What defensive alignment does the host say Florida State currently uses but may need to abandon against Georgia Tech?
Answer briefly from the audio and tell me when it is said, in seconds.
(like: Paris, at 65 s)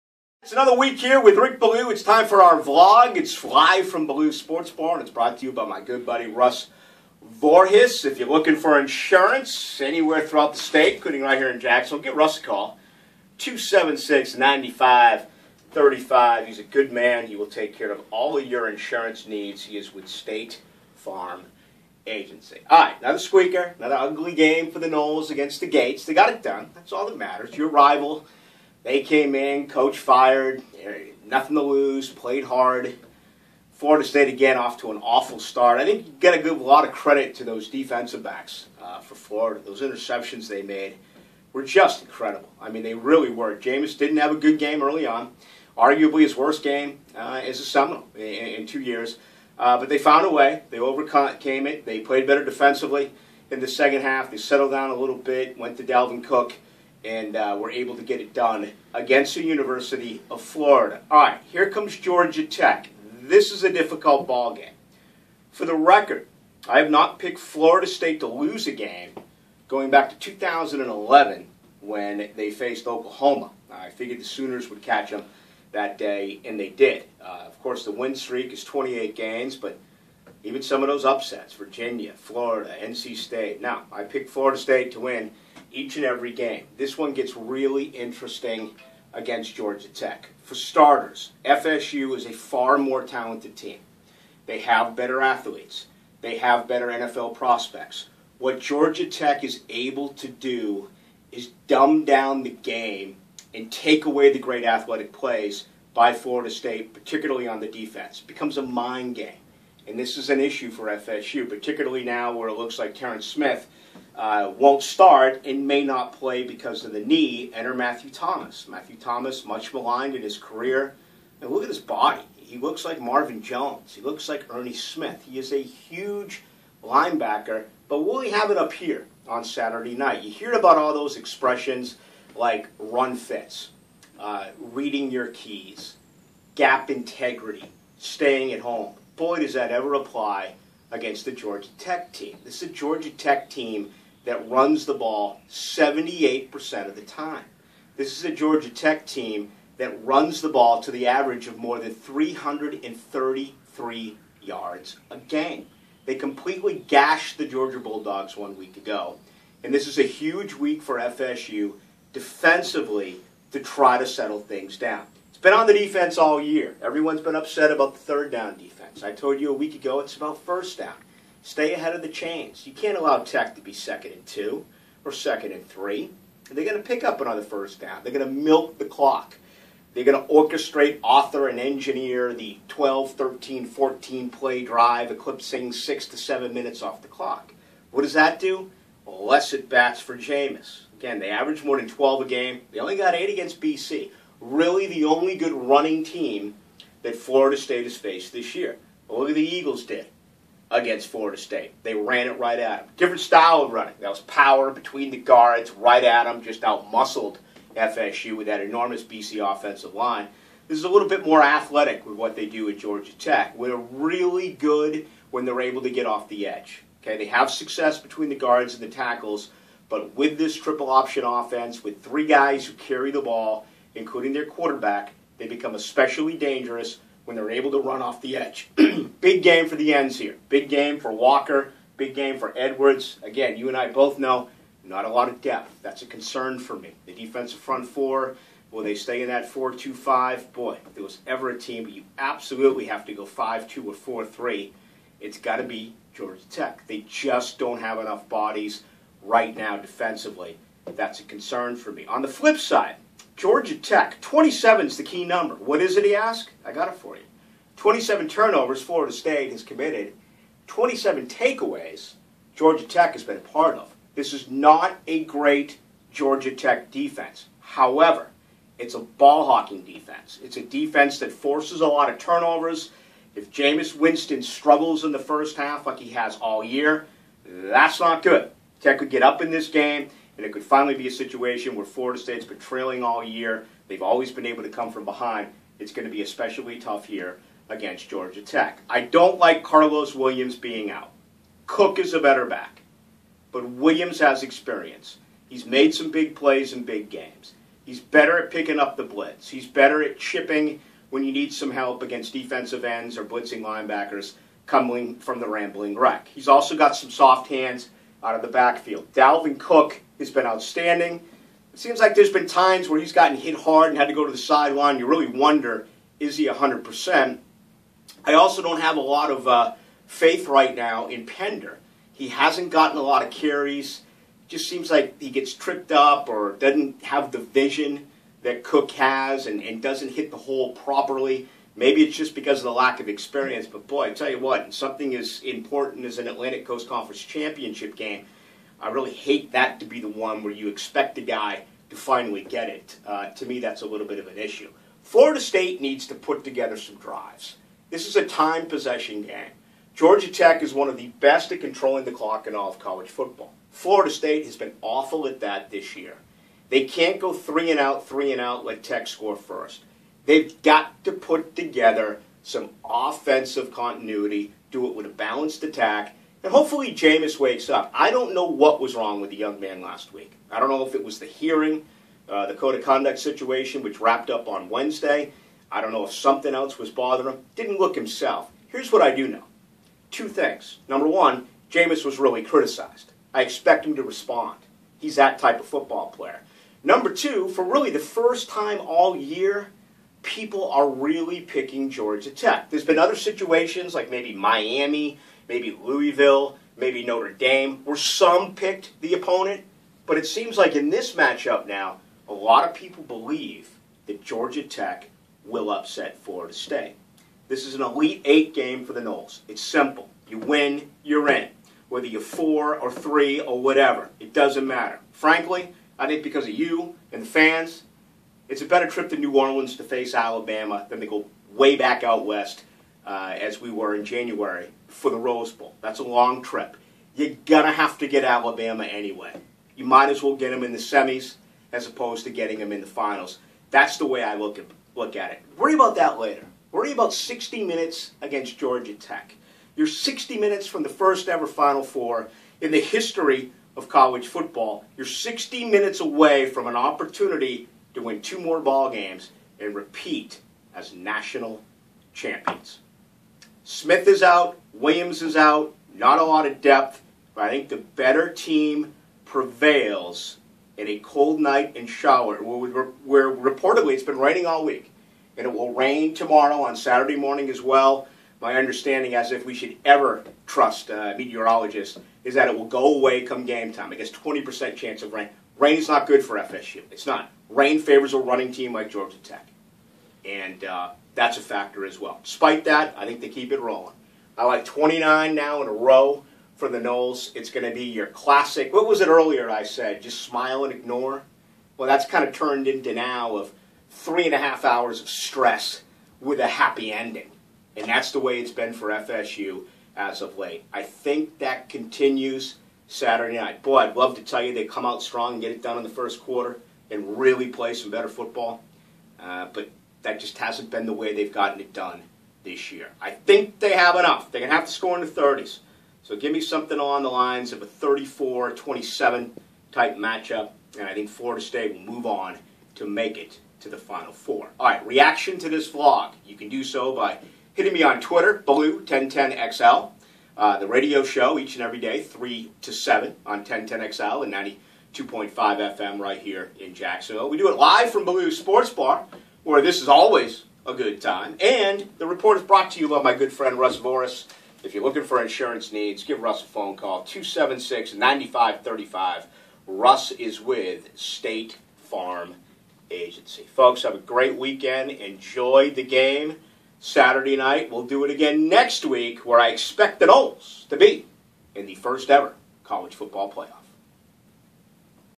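4 2 5, at 239 s.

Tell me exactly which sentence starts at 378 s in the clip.
Here's what I do know two things.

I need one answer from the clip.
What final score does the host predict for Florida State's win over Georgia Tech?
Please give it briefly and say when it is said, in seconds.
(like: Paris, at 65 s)
34-27, at 517 s.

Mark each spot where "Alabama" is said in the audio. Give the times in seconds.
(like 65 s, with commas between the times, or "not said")
420 s, 428 s.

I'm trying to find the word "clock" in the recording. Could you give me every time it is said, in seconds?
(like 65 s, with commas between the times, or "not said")
178 s, 187 s, 352 s.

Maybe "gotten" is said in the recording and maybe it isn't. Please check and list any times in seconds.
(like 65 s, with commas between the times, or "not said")
313 s, 322 s, 511 s.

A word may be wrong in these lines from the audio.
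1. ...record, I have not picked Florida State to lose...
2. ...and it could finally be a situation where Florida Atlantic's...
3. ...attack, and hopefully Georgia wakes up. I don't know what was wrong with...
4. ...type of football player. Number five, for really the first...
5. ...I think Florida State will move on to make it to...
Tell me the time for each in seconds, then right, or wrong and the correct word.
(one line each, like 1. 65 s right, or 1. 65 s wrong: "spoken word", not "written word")
1. 65 s right
2. 280 s wrong: "State", not "Atlantic"
3. 365 s wrong: "Jameis", not "Georgia"
4. 385 s wrong: "two", not "five"
5. 520 s right.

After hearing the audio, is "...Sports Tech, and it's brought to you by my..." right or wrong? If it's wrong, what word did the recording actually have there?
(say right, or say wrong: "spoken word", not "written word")
wrong: "Bar", not "Tech".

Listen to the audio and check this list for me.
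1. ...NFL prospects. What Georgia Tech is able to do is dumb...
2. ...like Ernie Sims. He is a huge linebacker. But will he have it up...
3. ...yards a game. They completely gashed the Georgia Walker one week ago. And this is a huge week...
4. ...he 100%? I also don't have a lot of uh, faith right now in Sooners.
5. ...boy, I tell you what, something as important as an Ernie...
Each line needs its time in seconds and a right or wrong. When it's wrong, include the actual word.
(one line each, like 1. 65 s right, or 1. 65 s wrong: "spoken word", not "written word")
1. 96 s right
2. 124 s right
3. 154 s wrong: "Bulldogs", not "Walker"
4. 316 s wrong: "Pender", not "Sooners"
5. 333 s wrong: "Atlantic", not "Ernie".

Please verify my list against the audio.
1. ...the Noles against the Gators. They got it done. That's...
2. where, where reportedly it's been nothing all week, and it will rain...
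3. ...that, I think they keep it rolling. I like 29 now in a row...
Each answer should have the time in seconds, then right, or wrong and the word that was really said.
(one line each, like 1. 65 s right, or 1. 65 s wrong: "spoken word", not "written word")
1. 24 s right
2. 462 s wrong: "raining", not "nothing"
3. 482 s right.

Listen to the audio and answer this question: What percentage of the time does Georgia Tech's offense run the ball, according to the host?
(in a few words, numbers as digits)
78%.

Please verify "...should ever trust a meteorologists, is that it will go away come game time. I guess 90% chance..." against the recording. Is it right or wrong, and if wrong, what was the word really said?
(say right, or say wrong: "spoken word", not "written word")
wrong: "20", not "90".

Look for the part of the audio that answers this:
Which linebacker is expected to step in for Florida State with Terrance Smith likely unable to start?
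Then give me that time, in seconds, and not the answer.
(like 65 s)
117 s.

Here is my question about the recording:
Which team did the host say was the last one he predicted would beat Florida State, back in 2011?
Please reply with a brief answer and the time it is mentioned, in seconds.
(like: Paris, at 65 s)
Oklahoma, at 72 s.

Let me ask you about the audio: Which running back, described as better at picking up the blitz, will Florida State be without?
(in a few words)
Carlos Williams.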